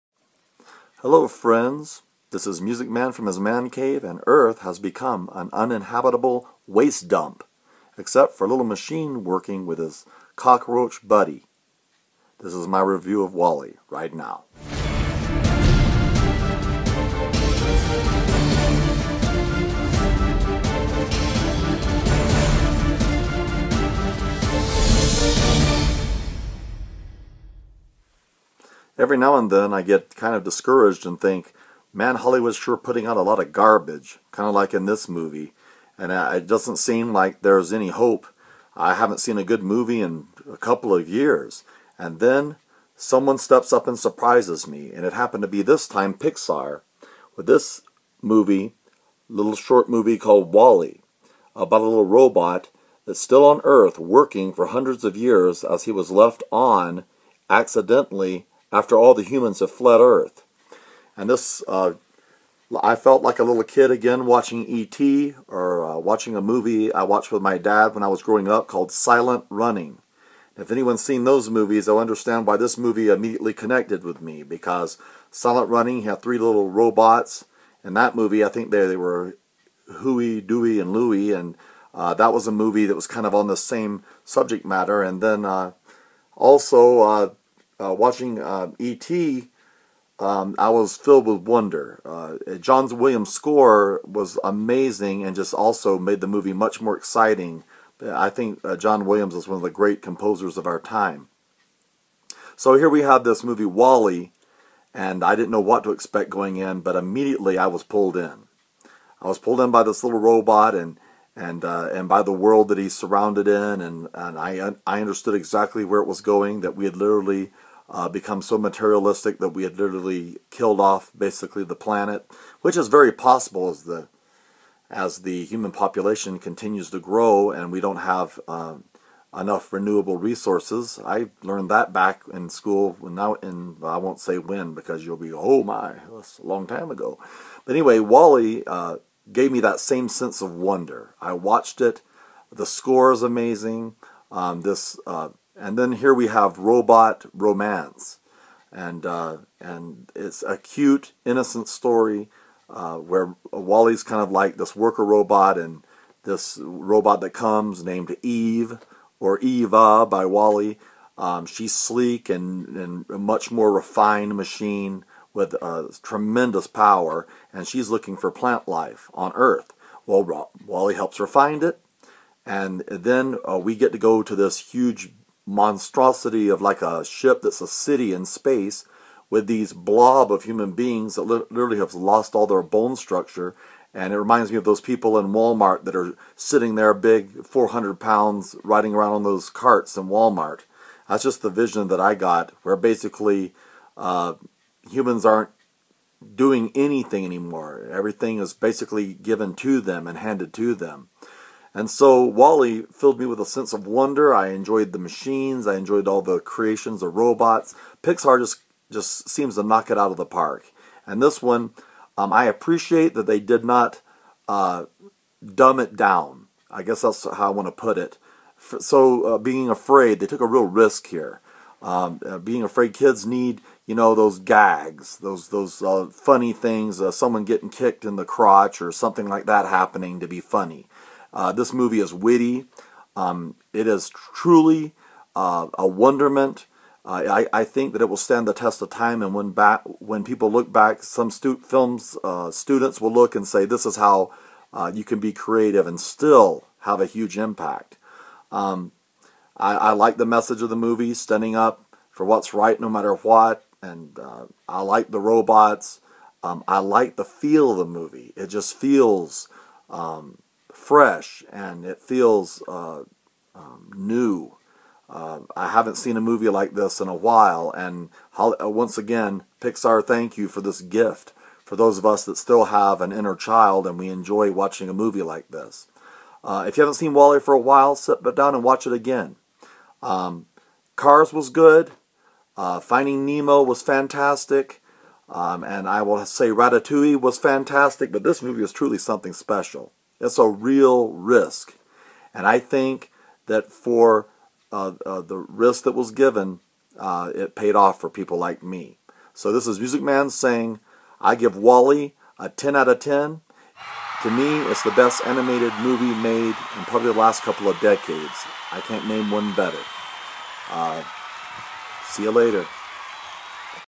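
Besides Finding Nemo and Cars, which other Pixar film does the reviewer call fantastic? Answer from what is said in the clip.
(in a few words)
Ratatouille.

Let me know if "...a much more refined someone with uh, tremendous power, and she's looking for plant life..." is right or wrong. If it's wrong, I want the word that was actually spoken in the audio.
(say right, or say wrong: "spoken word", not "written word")
wrong: "machine", not "someone".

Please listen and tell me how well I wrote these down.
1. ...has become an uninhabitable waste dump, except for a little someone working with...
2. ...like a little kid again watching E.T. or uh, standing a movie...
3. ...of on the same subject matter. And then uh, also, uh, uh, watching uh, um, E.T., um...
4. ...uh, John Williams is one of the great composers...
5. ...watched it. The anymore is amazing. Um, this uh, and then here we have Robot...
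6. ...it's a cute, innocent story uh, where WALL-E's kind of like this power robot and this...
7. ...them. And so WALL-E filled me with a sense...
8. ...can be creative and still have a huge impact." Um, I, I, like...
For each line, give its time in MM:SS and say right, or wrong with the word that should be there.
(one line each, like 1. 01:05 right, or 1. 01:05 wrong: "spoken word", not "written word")
1. 00:04 wrong: "machine", not "someone"
2. 01:03 wrong: "watching", not "standing"
3. 01:23 right
4. 01:38 right
5. 02:21 wrong: "score", not "anymore"
6. 02:30 wrong: "worker", not "power"
7. 03:20 right
8. 04:05 right.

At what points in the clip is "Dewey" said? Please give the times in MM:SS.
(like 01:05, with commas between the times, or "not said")
01:20.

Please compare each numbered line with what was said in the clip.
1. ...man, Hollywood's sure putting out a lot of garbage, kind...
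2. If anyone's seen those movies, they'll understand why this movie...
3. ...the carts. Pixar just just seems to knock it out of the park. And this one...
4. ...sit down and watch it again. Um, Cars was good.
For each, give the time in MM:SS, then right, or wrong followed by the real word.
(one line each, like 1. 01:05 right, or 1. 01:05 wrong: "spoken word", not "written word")
1. 00:31 right
2. 01:10 right
3. 03:26 wrong: "robots", not "carts"
4. 04:37 right.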